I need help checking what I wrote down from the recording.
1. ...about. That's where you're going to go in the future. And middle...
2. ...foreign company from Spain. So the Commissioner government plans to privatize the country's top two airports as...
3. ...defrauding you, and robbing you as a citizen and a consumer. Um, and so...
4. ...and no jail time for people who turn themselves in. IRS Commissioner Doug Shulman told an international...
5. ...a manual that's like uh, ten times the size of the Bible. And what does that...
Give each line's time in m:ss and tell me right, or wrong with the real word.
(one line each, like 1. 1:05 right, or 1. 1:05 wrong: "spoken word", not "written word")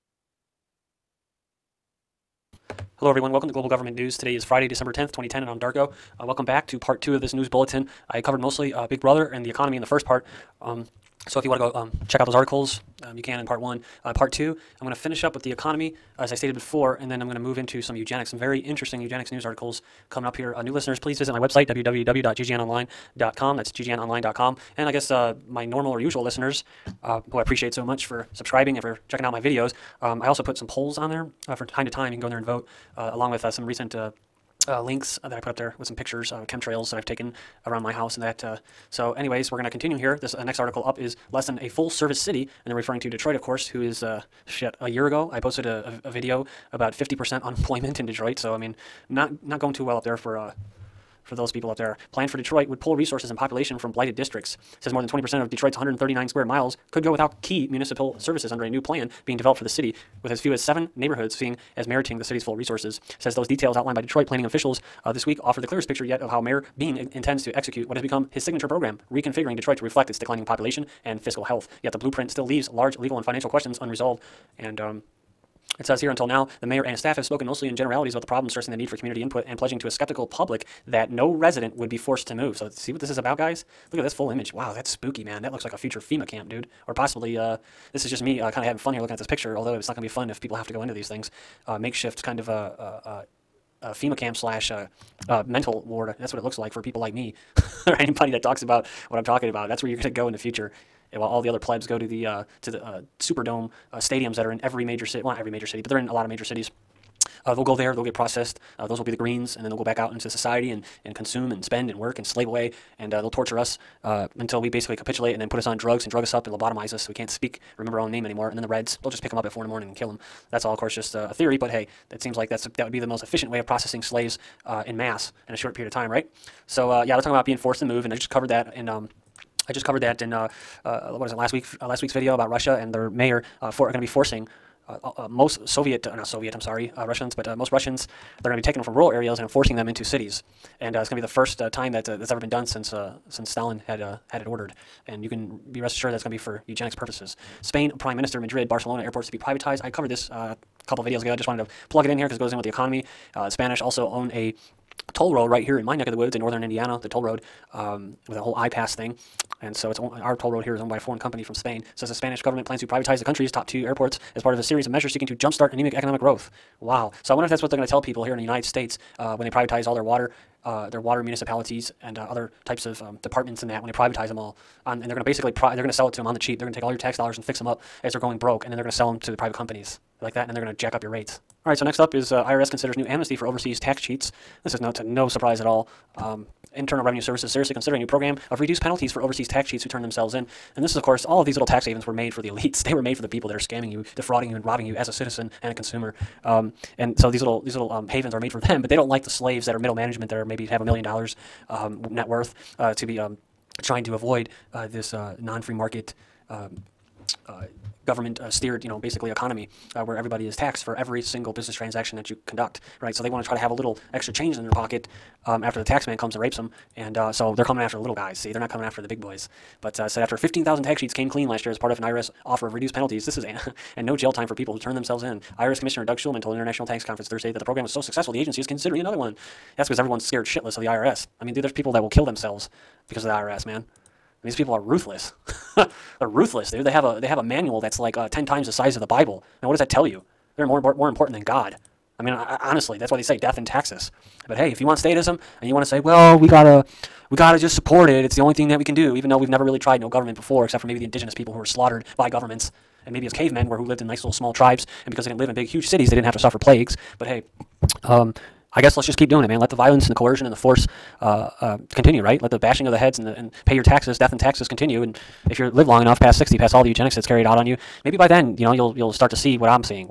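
1. 1:39 wrong: "while", not "middle"
2. 2:40 wrong: "Spanish", not "Commissioner"
3. 3:14 right
4. 3:43 right
5. 3:57 right.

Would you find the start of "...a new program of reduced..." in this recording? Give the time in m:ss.
3:08.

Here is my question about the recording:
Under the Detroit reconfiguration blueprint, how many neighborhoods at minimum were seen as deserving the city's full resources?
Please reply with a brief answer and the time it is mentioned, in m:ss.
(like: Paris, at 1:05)
7, at 1:00.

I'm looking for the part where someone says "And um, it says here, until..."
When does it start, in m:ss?
1:14.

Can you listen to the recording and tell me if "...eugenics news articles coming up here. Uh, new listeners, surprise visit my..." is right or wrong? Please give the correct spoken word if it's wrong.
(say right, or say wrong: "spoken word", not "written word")
wrong: "please", not "surprise".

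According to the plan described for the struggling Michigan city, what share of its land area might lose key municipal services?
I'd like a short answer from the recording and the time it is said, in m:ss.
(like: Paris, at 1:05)
more than 20%, at 0:54.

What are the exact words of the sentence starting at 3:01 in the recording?
All right, so next up is uh, IRS considers new amnesty for overseas tax cheats.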